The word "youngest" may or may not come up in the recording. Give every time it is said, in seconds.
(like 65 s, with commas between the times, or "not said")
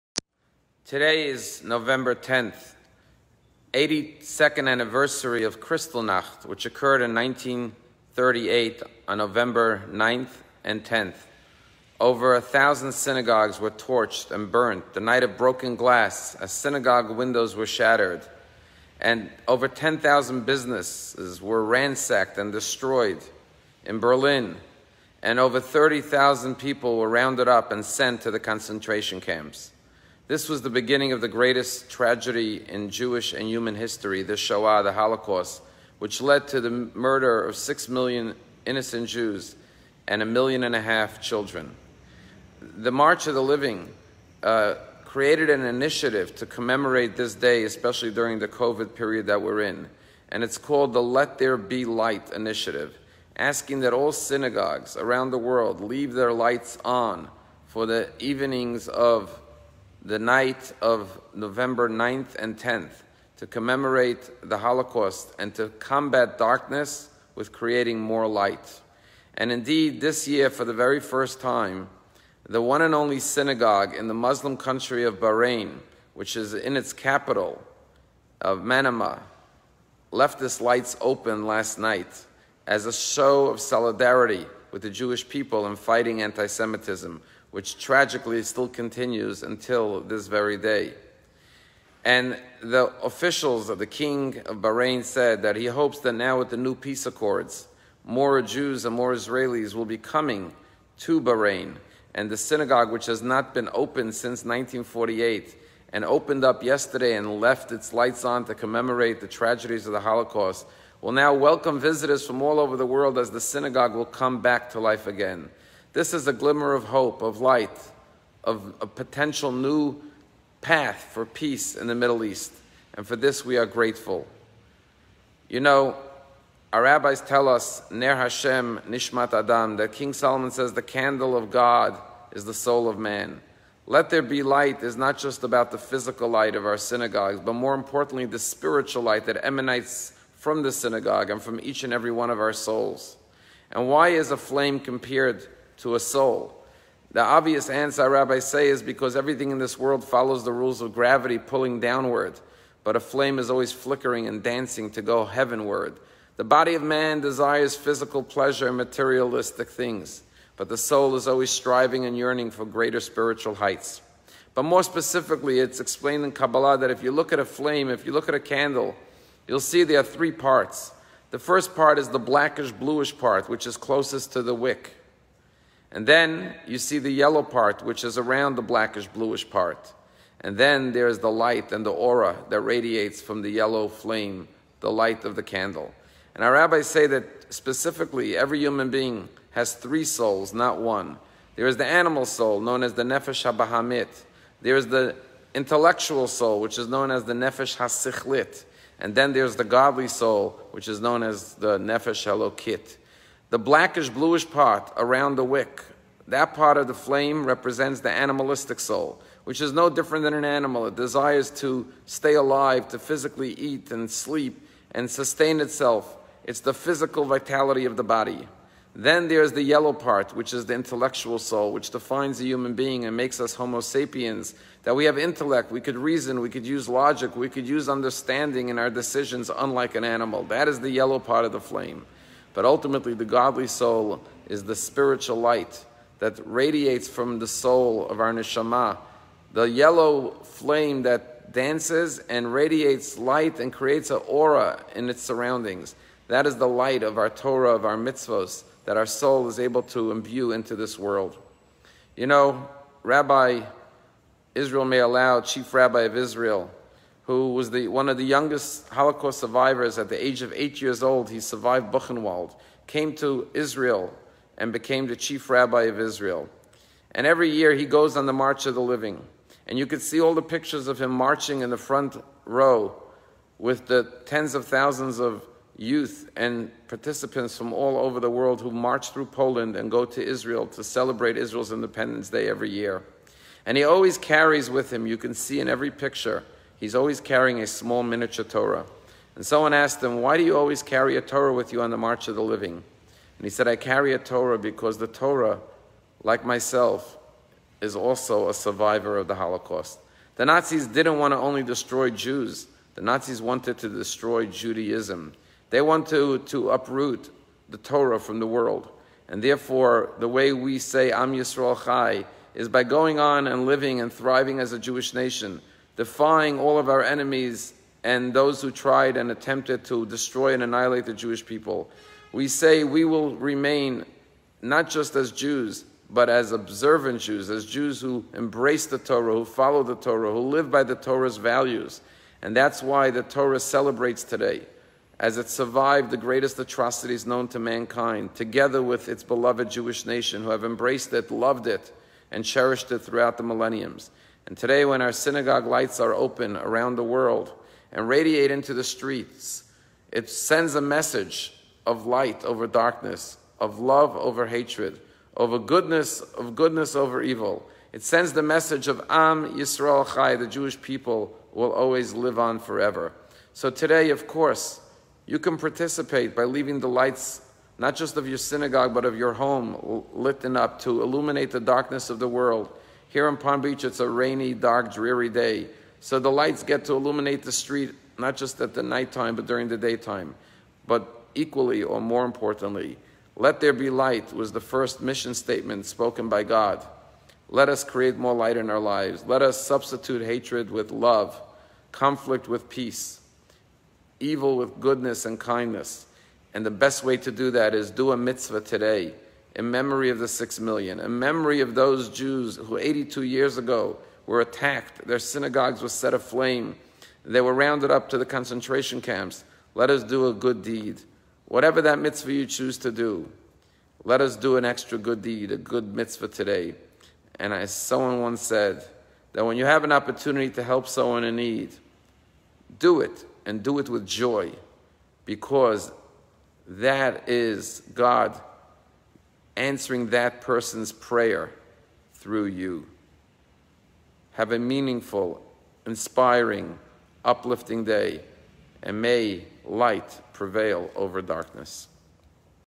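258 s.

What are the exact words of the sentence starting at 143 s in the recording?
And why is a flame compared to a soul.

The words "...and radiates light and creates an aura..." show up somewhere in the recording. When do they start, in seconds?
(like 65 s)
242 s.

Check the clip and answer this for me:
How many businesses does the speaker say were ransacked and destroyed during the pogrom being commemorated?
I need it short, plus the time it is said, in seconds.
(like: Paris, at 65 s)
over 10,000, at 19 s.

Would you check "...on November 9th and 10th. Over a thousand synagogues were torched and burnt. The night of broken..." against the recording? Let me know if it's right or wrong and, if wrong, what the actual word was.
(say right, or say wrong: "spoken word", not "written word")
right.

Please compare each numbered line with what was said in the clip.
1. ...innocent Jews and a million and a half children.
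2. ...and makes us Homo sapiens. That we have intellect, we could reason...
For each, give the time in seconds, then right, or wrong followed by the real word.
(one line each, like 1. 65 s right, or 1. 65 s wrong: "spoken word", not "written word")
1. 38 s right
2. 223 s right.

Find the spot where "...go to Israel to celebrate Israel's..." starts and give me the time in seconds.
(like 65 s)
279 s.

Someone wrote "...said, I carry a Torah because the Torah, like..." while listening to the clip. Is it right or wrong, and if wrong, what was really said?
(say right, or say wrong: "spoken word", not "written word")
right.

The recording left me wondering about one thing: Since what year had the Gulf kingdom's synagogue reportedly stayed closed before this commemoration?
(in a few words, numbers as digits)
1948.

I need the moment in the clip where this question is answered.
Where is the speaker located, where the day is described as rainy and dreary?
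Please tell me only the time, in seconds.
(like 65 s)
373 s.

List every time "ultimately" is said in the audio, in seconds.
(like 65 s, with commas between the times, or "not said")
232 s.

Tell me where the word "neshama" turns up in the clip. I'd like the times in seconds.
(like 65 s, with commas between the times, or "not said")
238 s.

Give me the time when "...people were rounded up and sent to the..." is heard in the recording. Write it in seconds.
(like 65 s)
26 s.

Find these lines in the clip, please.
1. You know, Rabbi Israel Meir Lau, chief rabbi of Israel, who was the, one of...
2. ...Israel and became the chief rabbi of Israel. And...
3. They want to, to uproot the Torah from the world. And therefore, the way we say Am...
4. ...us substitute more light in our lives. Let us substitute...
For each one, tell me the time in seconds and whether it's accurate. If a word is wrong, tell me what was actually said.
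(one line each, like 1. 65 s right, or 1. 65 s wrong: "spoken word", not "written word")
1. 252 s right
2. 263 s right
3. 305 s right
4. 387 s wrong: "create", not "substitute".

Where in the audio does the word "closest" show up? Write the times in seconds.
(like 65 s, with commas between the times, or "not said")
173 s.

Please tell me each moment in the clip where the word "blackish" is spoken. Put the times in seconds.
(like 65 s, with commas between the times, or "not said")
172 s, 178 s, 203 s.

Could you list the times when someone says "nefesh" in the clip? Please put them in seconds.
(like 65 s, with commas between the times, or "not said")
193 s, 197 s, 201 s.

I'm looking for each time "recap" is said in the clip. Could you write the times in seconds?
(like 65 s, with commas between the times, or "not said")
not said.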